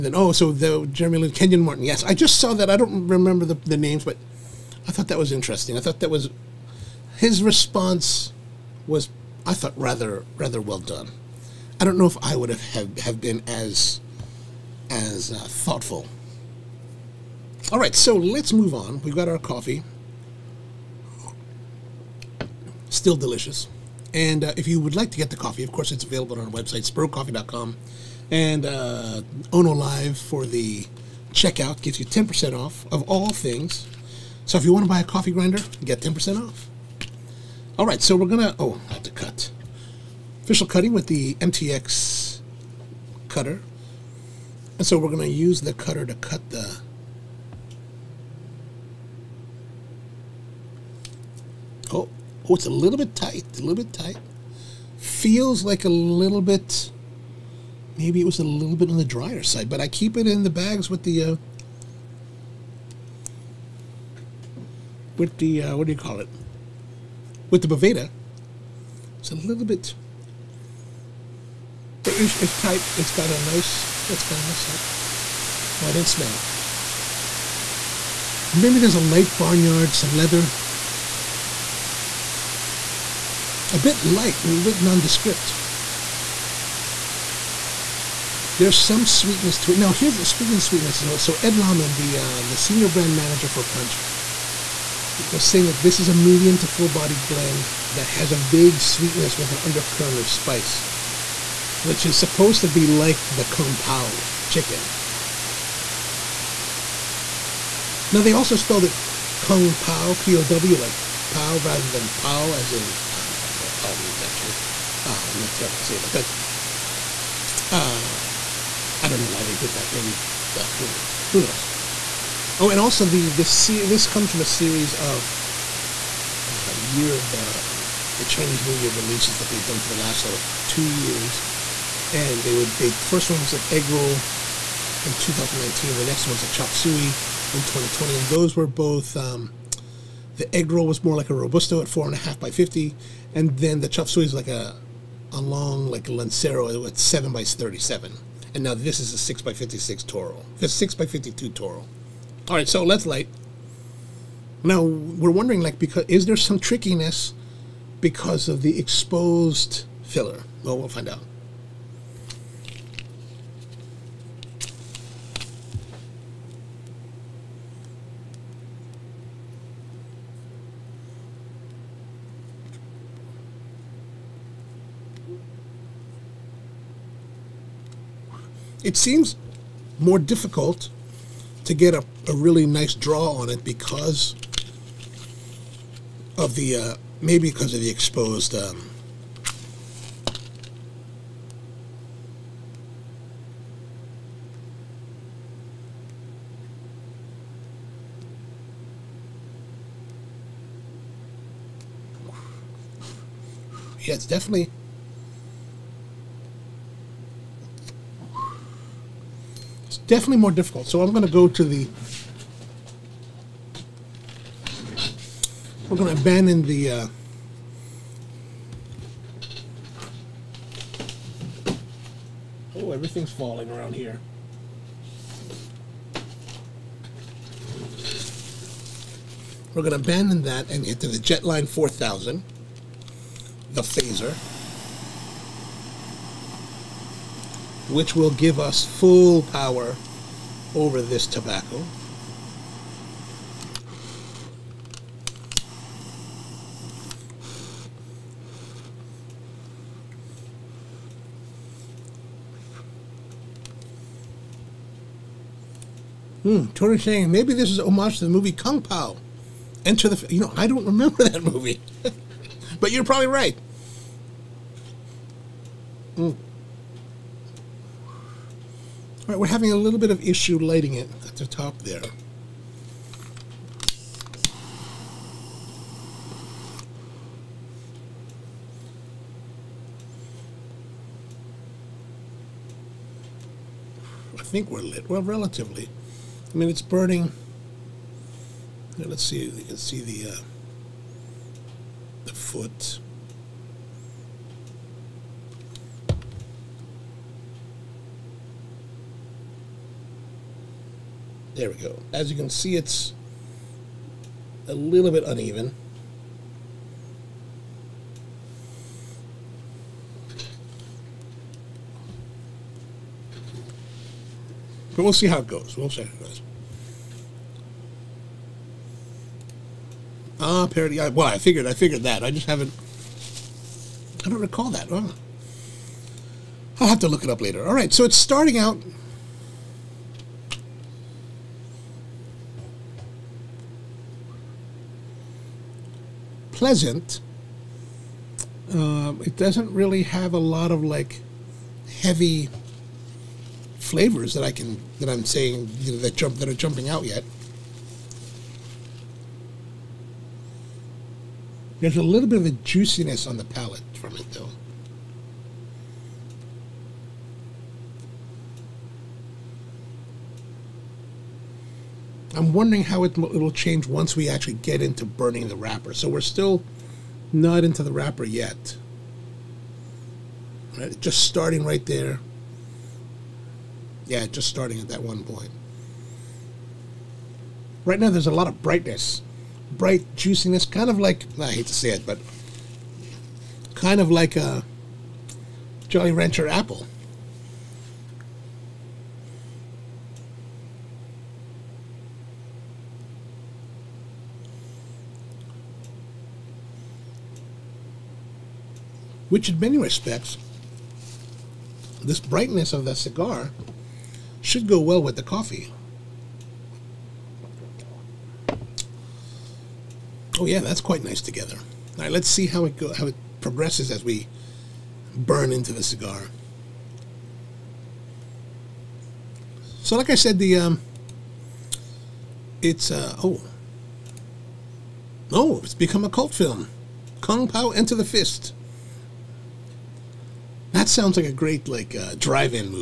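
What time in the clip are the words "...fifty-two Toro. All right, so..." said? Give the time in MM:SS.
02:31.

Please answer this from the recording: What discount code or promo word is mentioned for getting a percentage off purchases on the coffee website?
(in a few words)
Ono Live.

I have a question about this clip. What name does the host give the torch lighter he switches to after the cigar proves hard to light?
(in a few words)
Jetline 4000.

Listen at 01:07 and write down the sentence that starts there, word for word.
with the Boveda, it's a little bit, but it's, it's tight.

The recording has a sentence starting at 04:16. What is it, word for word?
Hmm, Tony saying maybe this is homage to the movie Kung Pow.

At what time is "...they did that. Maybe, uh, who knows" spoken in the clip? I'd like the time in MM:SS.
01:59.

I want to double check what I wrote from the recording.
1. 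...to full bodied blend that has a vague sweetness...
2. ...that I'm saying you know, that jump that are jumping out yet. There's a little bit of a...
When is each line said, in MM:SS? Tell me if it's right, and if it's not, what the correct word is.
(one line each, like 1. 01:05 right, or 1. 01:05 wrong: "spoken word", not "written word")
1. 01:36 right
2. 05:44 right.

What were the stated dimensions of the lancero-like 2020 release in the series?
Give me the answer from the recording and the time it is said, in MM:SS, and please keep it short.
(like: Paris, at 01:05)
7 by 37, at 02:26.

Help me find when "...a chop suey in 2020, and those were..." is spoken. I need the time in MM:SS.
02:16.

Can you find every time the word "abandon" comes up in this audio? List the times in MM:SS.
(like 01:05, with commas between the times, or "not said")
03:36, 03:49.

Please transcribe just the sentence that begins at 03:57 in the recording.
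which will give us full power over this tobacco.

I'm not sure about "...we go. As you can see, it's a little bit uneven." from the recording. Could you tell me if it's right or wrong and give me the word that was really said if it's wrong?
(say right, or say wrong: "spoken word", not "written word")
right.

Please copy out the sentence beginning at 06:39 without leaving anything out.
which in many respects, this brightness of the cigar should go well with the coffee.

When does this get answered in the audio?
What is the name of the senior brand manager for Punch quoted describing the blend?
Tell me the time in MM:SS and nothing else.
01:31.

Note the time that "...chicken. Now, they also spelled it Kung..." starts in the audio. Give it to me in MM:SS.
01:44.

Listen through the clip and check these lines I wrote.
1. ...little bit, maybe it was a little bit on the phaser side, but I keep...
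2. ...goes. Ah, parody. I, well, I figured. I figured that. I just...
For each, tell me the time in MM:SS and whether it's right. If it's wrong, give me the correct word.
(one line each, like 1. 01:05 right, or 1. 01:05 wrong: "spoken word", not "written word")
1. 00:55 wrong: "drier", not "phaser"
2. 05:16 right.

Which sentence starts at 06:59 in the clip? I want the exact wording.
So, like I said, the um, it's uh, oh, oh, it's become a cult film, Kung Pow Enter the Fist.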